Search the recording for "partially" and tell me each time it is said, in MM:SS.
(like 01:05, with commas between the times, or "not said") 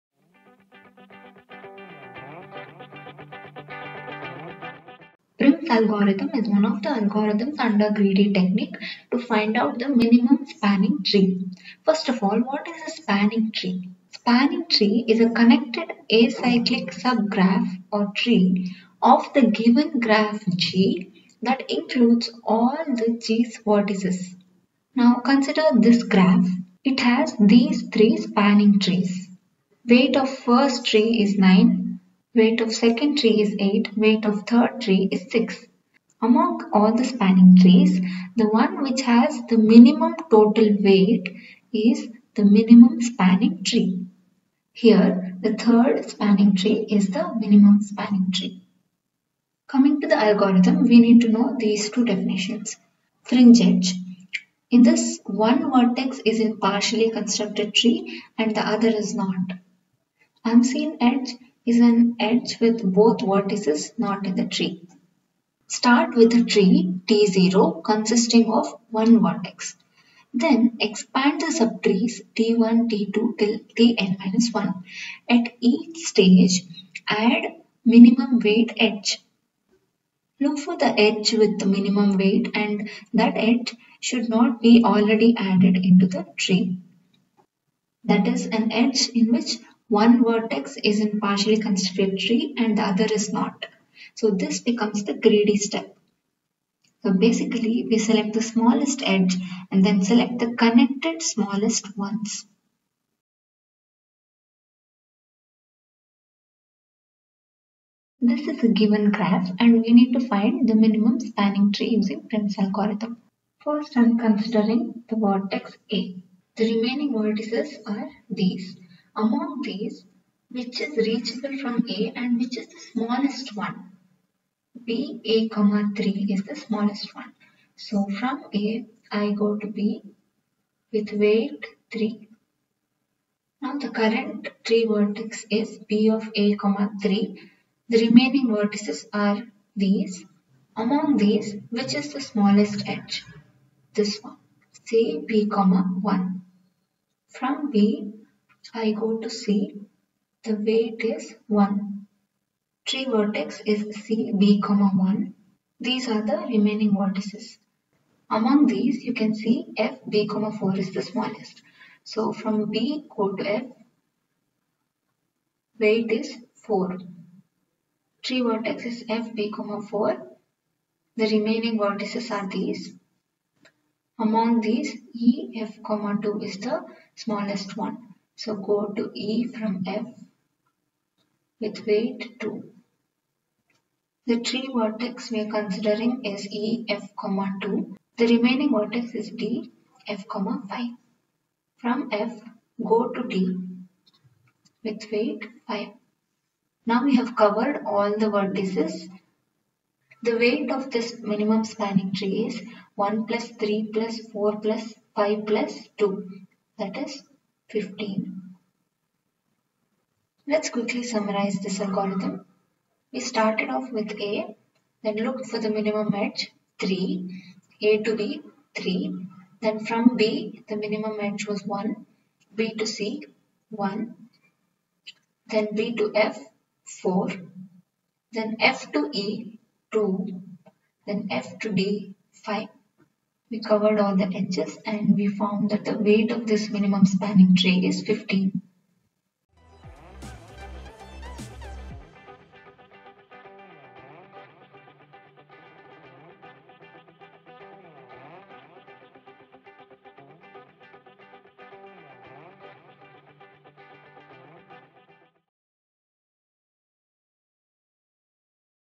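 00:56, 01:31.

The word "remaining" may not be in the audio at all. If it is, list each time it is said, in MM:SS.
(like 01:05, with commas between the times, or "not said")
01:56, 02:18, 02:36, 02:51, 03:08.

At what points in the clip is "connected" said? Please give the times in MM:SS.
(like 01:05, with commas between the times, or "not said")
00:15, 01:40.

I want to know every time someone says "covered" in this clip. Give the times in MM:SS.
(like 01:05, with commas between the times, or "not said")
03:17, 03:53.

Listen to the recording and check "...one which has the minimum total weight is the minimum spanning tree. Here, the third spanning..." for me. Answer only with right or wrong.
right.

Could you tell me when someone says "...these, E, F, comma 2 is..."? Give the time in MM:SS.
02:54.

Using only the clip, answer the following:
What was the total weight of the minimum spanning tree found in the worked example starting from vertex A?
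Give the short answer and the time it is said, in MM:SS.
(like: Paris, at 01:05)
15, at 03:26.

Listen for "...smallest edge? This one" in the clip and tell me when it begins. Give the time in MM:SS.
02:22.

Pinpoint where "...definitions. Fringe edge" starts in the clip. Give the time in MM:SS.
00:52.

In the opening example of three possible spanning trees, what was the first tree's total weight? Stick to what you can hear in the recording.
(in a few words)
9.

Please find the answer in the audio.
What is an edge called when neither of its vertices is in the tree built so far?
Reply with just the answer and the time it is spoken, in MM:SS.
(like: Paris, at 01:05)
Unseen edge, at 01:00.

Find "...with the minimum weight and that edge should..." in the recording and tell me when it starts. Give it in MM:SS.
01:21.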